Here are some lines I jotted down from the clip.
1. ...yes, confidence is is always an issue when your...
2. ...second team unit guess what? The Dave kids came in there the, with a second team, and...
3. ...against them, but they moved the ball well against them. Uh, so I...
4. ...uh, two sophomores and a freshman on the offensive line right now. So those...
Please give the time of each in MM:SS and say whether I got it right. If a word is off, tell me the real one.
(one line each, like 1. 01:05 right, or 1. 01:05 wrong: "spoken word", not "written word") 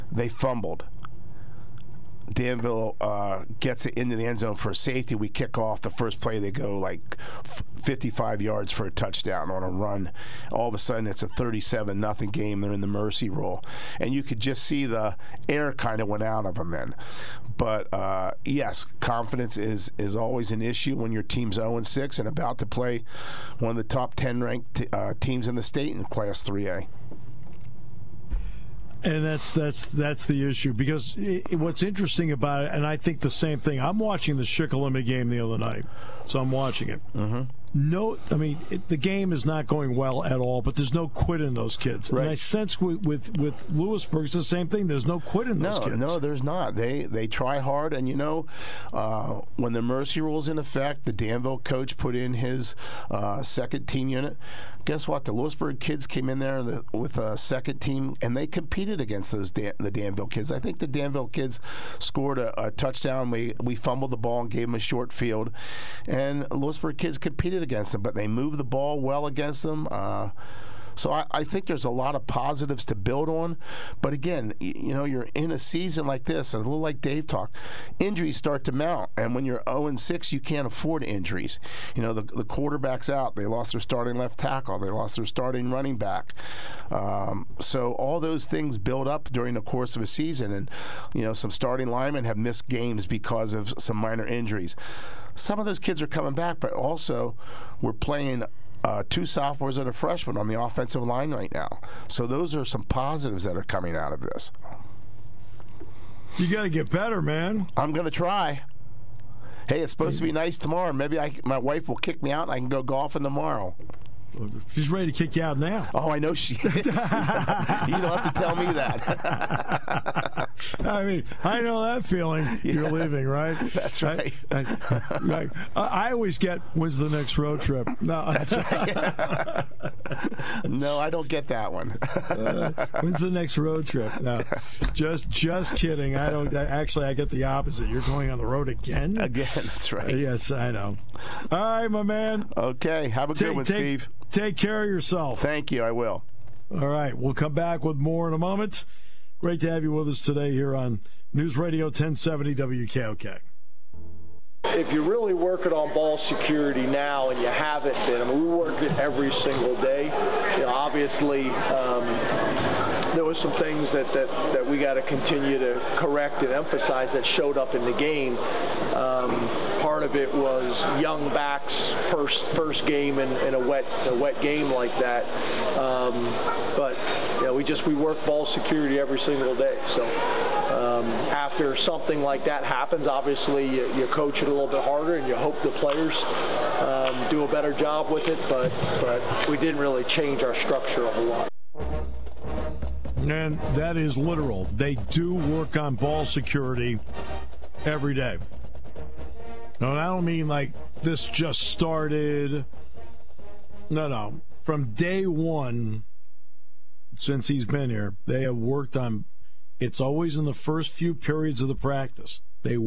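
1. 00:18 right
2. 00:53 wrong: "Lewisburg", not "Dave"
3. 01:07 right
4. 01:38 right.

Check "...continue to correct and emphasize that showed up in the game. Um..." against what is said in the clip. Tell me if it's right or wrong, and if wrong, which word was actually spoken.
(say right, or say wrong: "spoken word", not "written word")
right.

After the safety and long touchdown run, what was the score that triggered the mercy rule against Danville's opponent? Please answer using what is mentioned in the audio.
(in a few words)
37-0.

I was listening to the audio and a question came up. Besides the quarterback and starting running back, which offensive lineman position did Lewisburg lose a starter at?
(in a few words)
Left tackle.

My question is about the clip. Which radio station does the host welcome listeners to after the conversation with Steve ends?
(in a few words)
News Radio 1070 WKOK.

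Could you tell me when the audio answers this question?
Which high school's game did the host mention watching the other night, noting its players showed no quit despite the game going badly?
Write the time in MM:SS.
00:34.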